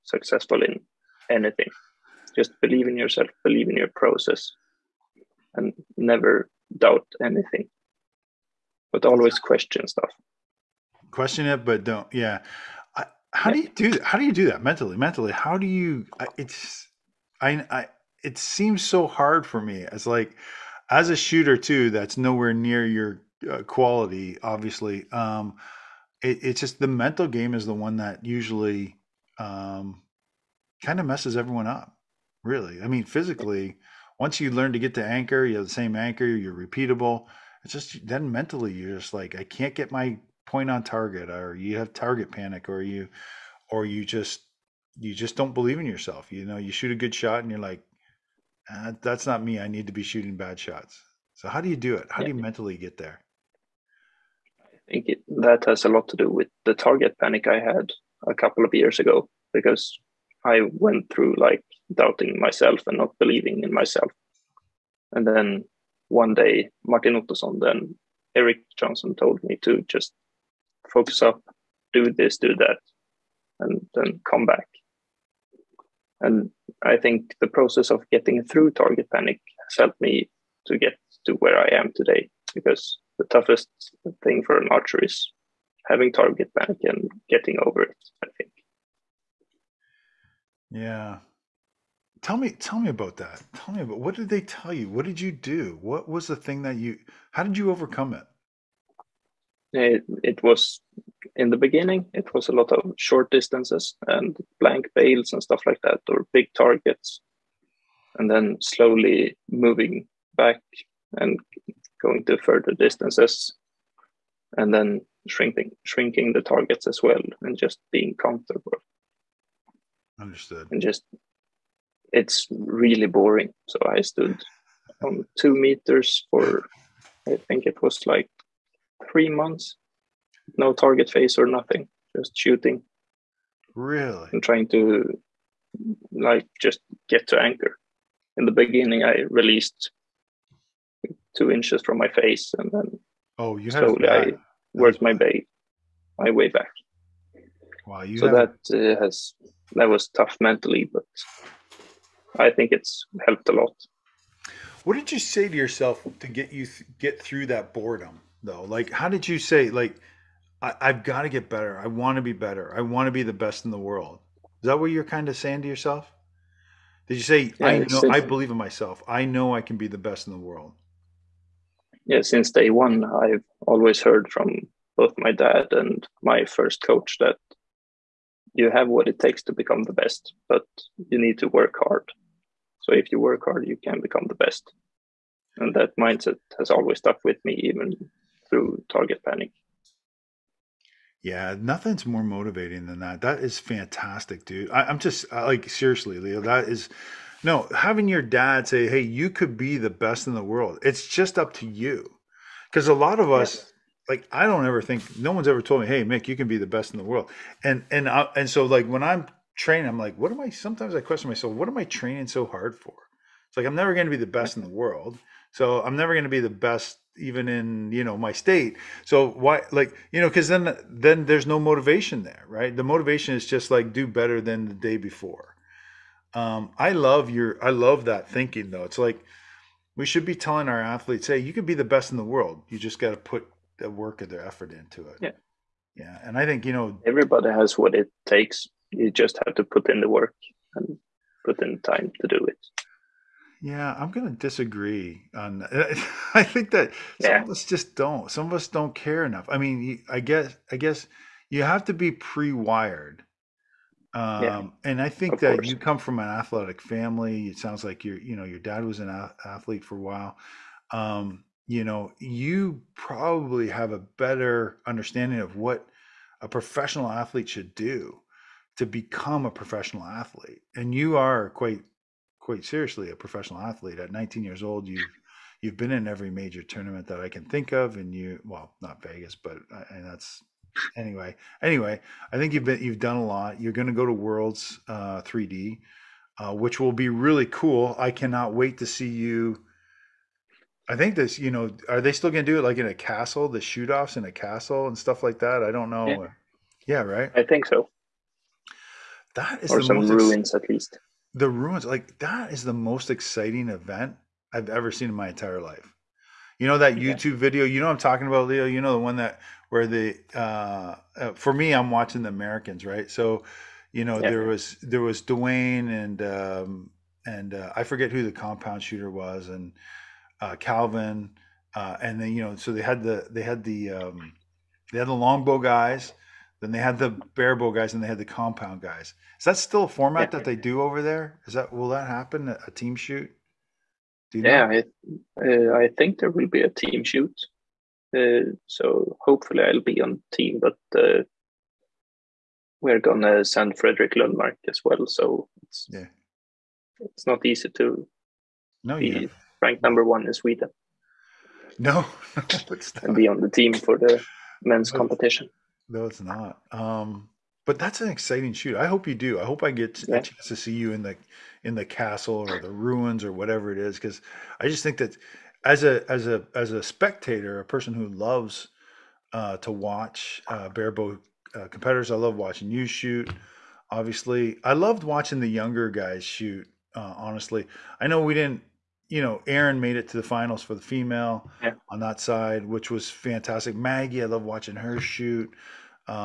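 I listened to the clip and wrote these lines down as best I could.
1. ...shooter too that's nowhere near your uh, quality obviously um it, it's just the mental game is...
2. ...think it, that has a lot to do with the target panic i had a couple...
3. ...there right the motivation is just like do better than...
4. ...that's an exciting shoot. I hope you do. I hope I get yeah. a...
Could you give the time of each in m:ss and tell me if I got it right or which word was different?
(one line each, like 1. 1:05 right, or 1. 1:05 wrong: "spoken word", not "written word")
1. 0:21 right
2. 0:54 right
3. 3:42 right
4. 5:57 right.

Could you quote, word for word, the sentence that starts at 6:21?
on that side, which was fantastic.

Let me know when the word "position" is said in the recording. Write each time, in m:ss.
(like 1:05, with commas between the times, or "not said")
not said.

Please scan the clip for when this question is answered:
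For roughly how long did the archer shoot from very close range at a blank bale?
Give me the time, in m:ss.
2:09.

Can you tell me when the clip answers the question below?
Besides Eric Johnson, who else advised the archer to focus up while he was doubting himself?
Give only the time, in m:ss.
1:06.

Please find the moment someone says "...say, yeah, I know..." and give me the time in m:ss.
2:47.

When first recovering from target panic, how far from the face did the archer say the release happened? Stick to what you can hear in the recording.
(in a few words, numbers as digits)
2 inches.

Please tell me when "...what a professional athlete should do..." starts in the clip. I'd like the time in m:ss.
4:25.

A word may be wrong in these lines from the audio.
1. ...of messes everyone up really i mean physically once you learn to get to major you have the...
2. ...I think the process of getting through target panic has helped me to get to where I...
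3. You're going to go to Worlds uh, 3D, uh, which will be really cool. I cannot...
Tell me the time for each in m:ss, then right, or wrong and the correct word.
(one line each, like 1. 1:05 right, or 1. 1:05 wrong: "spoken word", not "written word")
1. 0:31 wrong: "anchor", not "major"
2. 1:16 right
3. 4:43 right.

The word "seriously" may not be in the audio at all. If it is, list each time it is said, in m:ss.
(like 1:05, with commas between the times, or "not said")
3:15, 4:32.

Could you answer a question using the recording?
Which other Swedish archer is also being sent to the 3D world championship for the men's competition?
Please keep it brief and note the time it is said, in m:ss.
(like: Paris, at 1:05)
Fredrik Lundmark, at 5:43.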